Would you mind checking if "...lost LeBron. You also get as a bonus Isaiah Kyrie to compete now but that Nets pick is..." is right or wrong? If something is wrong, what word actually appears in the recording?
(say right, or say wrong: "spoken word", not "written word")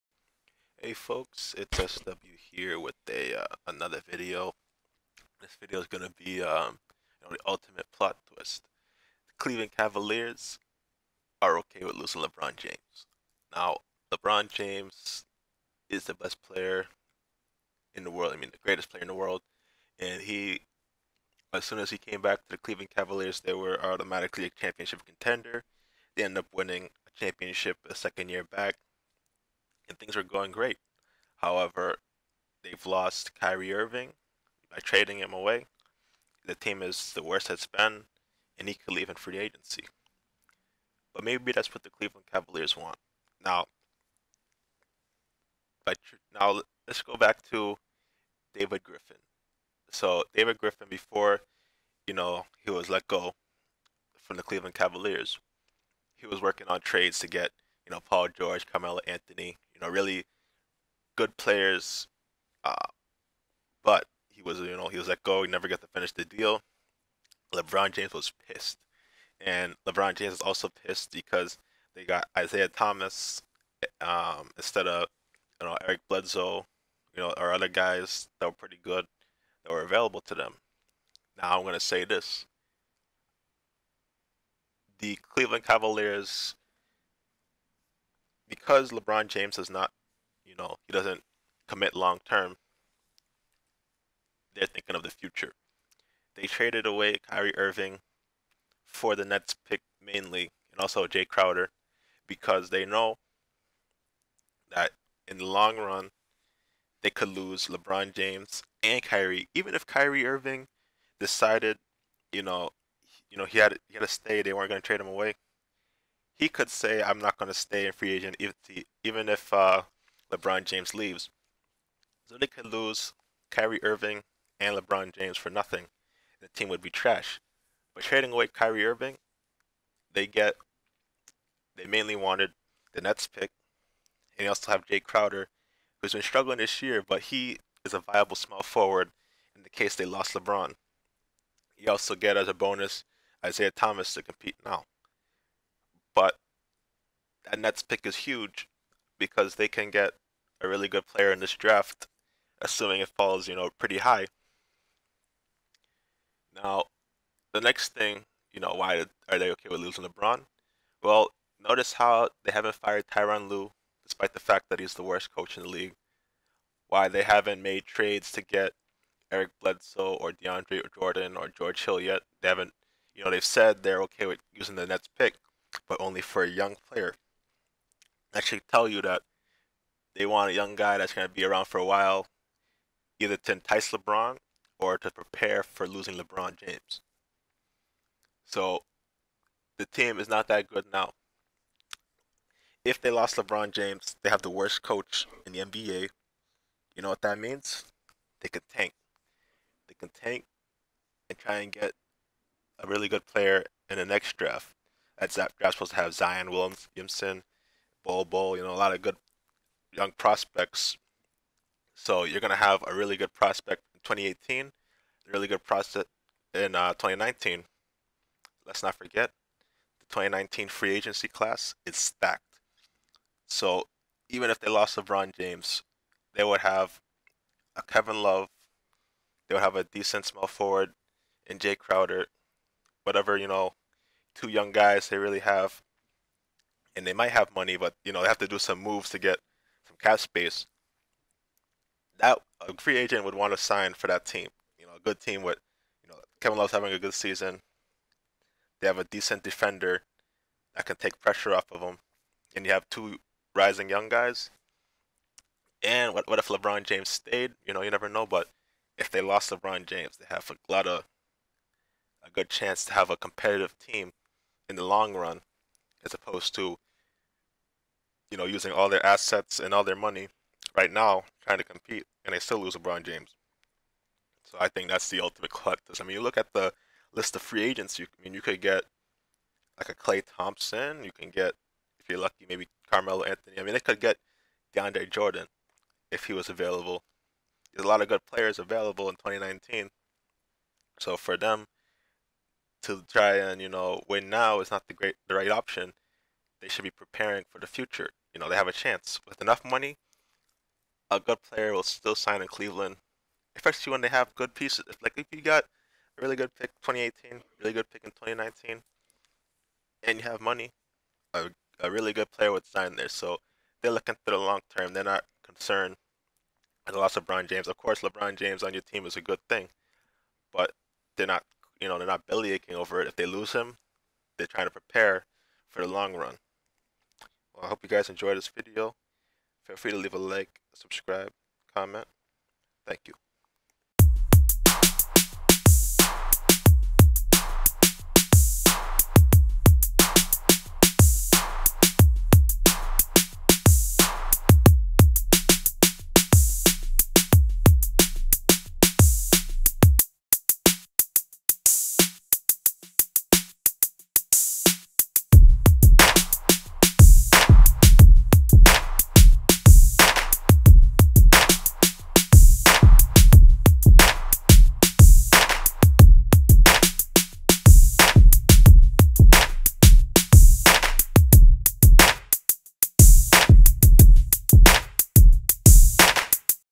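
wrong: "Thomas", not "Kyrie".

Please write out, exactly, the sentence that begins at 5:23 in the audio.
If they lose him, they're trying to prepare for the long run.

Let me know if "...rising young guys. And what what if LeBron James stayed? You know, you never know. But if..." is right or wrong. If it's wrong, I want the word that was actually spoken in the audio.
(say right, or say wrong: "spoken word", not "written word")
right.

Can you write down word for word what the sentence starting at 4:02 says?
That a free agent would want to sign for that team.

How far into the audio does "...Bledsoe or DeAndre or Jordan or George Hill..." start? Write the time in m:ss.
2:49.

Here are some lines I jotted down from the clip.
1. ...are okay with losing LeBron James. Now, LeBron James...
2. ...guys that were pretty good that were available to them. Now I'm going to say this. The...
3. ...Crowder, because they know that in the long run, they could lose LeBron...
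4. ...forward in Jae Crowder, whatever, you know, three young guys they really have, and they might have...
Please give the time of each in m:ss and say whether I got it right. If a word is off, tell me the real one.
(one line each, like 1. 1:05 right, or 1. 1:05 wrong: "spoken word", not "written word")
1. 0:11 right
2. 1:17 right
3. 1:41 right
4. 3:50 wrong: "two", not "three".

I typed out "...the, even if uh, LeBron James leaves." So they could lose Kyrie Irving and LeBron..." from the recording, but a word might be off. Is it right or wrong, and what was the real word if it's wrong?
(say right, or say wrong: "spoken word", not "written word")
right.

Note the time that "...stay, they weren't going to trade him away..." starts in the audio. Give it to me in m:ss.
1:54.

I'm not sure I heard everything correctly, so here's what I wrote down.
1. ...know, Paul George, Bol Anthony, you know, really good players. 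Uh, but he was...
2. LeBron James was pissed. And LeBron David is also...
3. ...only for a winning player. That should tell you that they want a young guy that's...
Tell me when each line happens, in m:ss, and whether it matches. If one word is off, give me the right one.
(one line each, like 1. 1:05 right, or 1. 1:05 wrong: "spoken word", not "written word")
1. 0:57 wrong: "Carmelo", not "Bol"
2. 1:07 wrong: "James", not "David"
3. 2:56 wrong: "young", not "winning".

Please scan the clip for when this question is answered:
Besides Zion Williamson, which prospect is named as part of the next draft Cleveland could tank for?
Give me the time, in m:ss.
3:28.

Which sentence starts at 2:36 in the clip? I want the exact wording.
Now, the next thing, you know, why are they okay with losing LeBron?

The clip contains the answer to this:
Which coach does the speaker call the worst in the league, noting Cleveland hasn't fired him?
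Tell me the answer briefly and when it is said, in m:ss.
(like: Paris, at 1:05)
Tyronn Lue, at 2:43.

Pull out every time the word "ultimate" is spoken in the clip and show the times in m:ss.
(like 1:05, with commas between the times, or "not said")
0:07, 4:35.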